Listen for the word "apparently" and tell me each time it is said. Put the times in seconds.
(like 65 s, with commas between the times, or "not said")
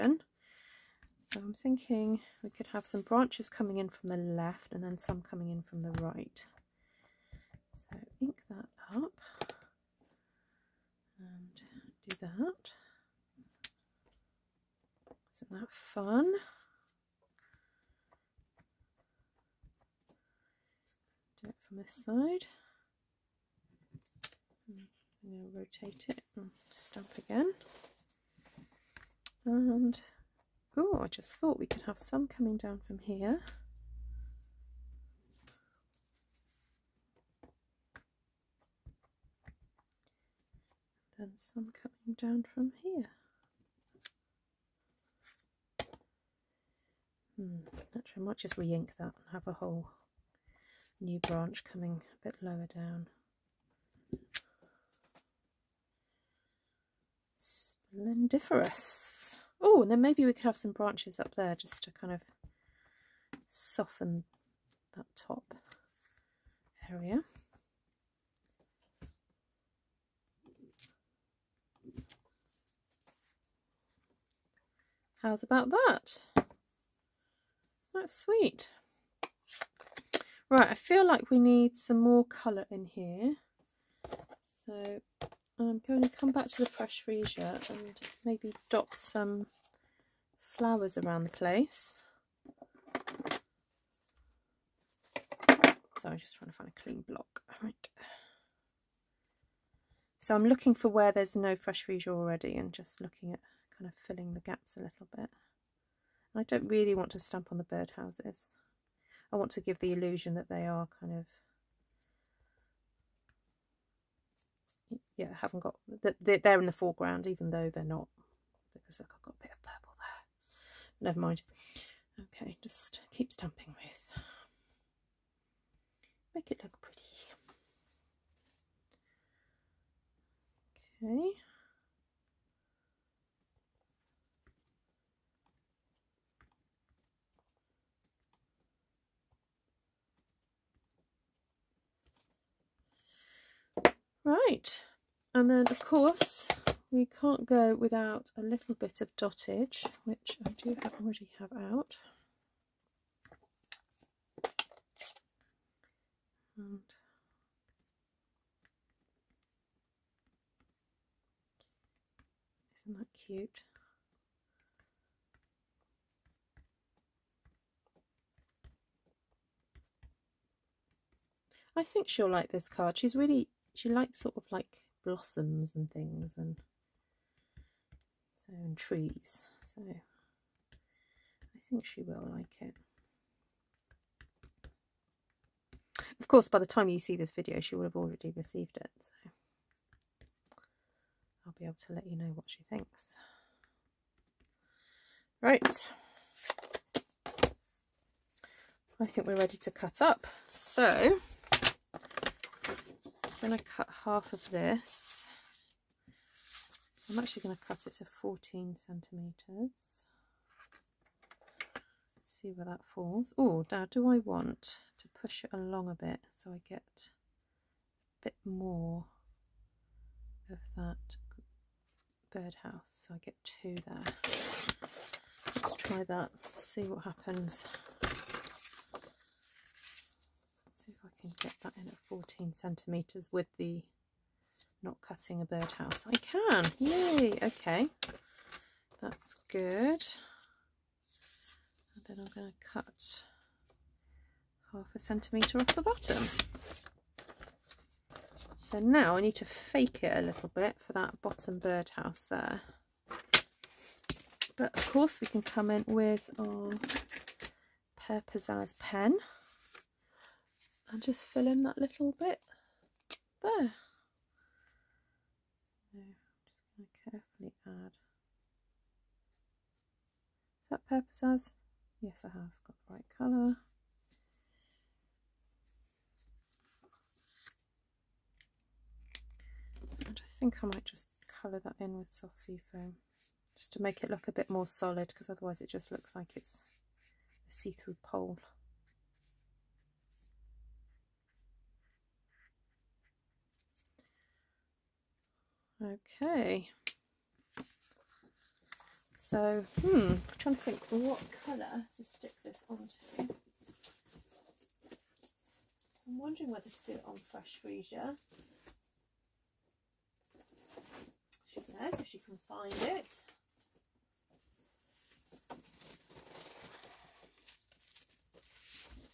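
not said.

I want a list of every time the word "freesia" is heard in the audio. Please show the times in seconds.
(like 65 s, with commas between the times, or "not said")
87 s, 101 s, 307 s.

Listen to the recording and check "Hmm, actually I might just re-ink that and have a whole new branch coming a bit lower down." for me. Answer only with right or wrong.
right.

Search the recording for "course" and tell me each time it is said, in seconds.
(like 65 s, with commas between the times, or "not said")
145 s, 186 s, 254 s.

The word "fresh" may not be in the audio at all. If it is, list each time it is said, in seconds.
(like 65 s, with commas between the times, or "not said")
86 s, 101 s, 307 s.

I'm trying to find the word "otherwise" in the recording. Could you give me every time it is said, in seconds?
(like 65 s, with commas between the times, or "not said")
285 s.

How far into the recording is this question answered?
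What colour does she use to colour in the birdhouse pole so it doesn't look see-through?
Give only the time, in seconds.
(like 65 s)
282 s.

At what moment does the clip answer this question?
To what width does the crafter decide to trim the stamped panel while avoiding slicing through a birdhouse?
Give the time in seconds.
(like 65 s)
208 s.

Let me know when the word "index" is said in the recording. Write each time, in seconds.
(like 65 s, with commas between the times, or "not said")
not said.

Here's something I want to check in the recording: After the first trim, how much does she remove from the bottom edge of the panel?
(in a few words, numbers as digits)
Half a centimetre.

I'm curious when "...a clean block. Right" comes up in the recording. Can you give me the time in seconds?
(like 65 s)
96 s.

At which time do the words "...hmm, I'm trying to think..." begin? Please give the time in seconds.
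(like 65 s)
299 s.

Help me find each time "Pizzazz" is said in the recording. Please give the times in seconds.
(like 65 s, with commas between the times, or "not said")
258 s, 271 s.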